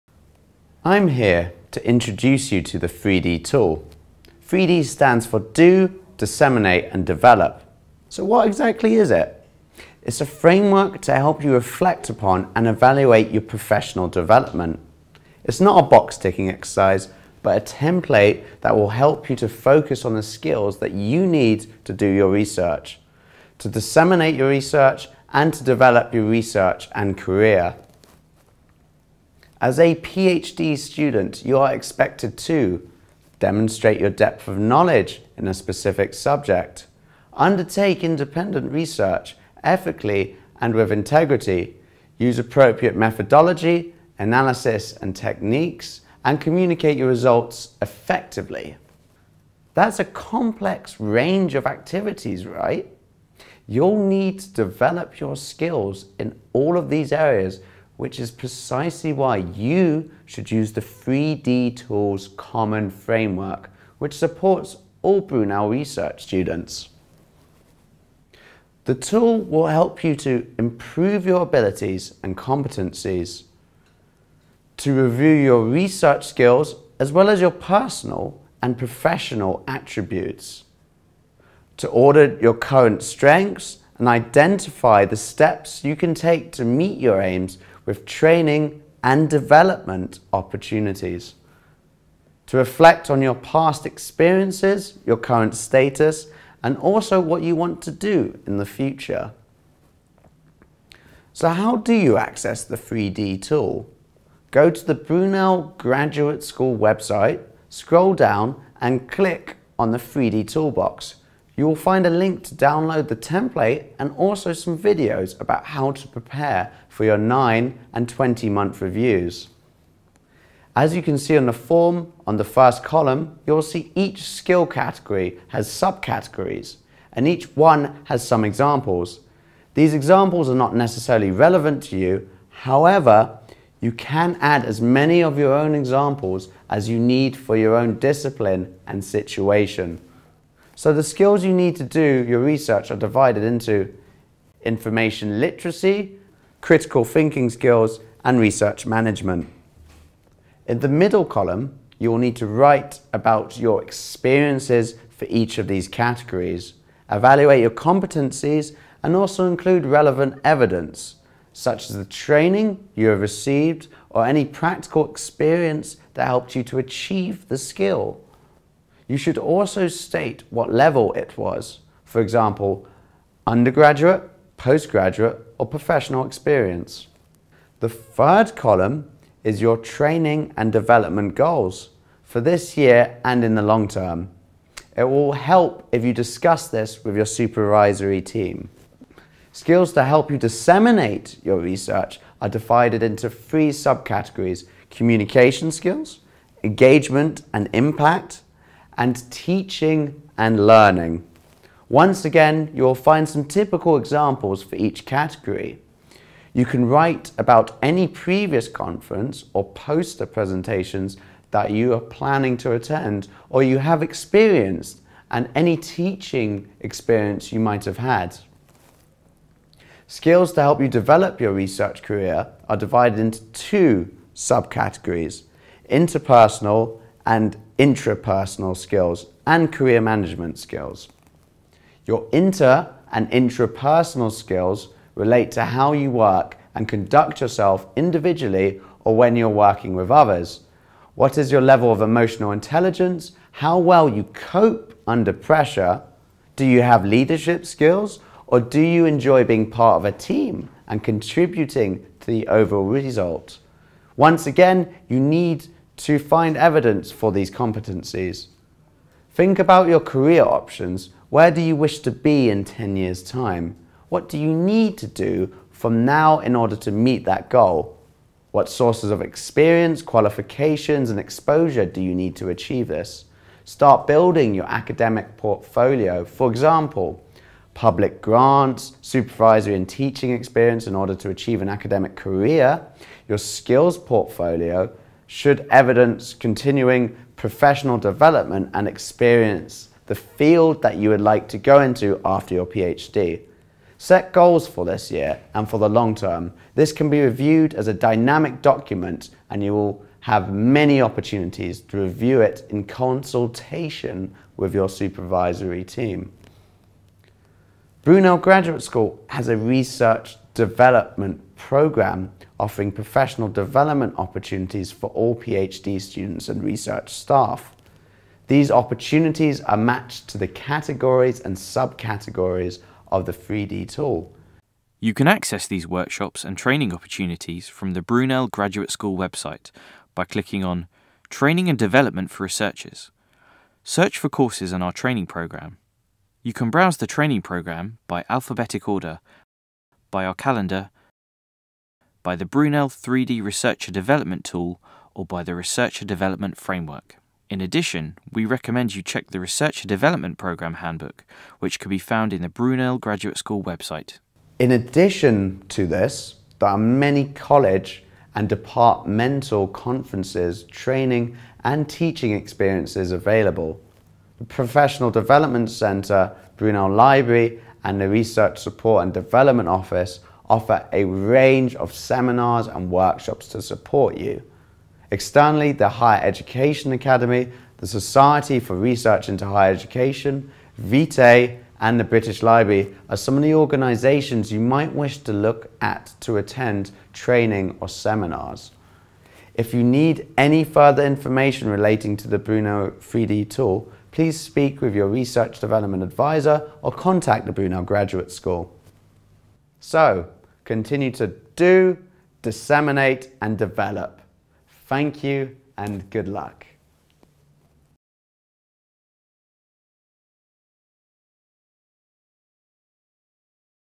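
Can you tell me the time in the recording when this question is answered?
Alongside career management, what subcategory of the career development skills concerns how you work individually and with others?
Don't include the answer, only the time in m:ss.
3:45.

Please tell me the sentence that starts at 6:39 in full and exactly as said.
So, continue to do, disseminate and develop.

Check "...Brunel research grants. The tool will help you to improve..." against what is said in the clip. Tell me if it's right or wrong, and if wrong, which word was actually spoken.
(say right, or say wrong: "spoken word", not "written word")
wrong: "students", not "grants".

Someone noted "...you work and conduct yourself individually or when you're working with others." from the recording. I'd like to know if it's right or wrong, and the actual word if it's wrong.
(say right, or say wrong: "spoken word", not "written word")
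right.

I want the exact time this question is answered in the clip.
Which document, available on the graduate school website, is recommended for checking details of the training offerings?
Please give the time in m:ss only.
5:49.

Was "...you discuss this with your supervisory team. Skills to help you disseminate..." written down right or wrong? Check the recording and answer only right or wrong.
right.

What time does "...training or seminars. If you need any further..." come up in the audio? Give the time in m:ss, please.
6:27.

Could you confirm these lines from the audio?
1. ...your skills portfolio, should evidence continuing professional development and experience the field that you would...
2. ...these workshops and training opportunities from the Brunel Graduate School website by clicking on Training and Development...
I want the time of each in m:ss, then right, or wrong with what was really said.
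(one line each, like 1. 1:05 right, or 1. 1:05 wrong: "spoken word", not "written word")
1. 4:43 right
2. 5:25 right.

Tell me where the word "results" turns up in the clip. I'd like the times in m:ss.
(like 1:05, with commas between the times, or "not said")
0:47, 4:12.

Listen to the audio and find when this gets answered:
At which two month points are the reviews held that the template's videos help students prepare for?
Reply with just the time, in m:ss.
1:57.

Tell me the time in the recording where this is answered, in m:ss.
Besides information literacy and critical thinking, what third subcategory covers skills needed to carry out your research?
2:28.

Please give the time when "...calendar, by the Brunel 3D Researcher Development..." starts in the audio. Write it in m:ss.
5:40.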